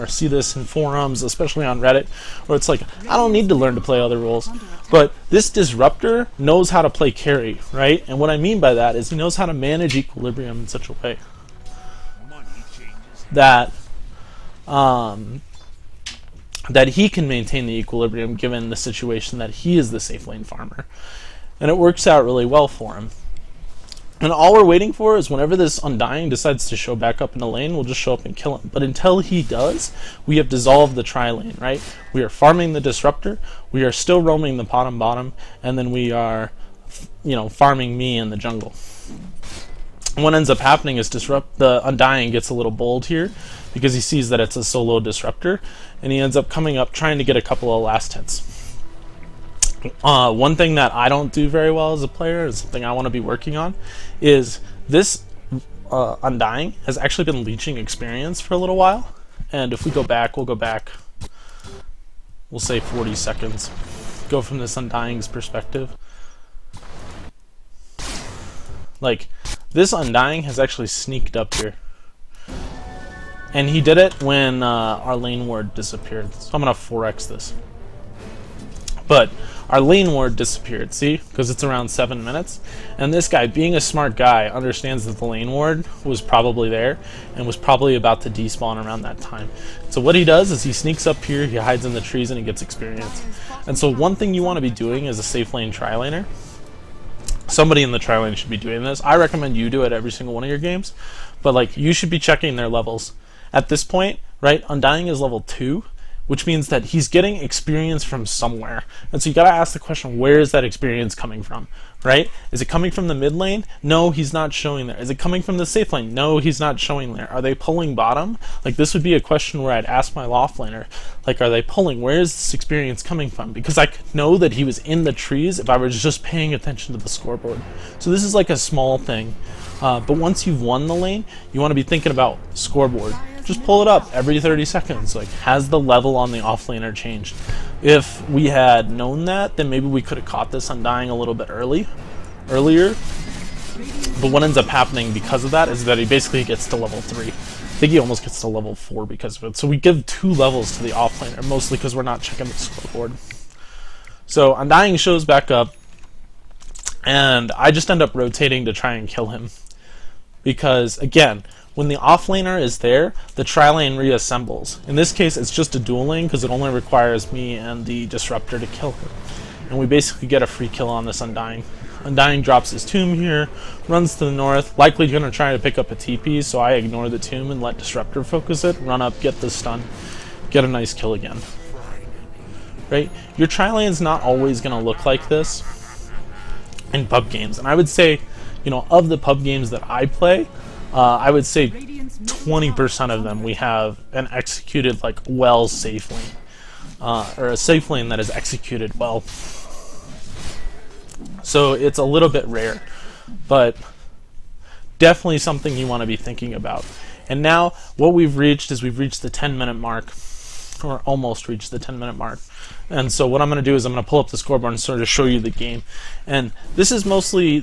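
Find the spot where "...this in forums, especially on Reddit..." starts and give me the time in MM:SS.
00:00.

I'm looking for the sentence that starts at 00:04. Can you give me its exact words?
But this disruptor knows how to play carry, right?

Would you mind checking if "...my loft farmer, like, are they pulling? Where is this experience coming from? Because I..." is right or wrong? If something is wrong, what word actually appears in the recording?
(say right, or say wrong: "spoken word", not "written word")
wrong: "laner", not "farmer".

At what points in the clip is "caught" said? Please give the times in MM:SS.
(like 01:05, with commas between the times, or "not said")
02:20.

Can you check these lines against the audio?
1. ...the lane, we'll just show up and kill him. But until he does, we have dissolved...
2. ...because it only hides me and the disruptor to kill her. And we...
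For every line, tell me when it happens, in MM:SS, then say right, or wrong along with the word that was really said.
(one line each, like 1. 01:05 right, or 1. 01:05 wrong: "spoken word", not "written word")
1. 00:27 right
2. 02:46 wrong: "requires", not "hides".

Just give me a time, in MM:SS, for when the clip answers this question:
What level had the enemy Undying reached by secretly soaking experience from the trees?
01:45.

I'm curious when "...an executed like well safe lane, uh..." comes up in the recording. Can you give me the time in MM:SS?
03:14.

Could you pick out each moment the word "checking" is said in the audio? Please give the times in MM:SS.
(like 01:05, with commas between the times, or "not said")
01:42, 02:32.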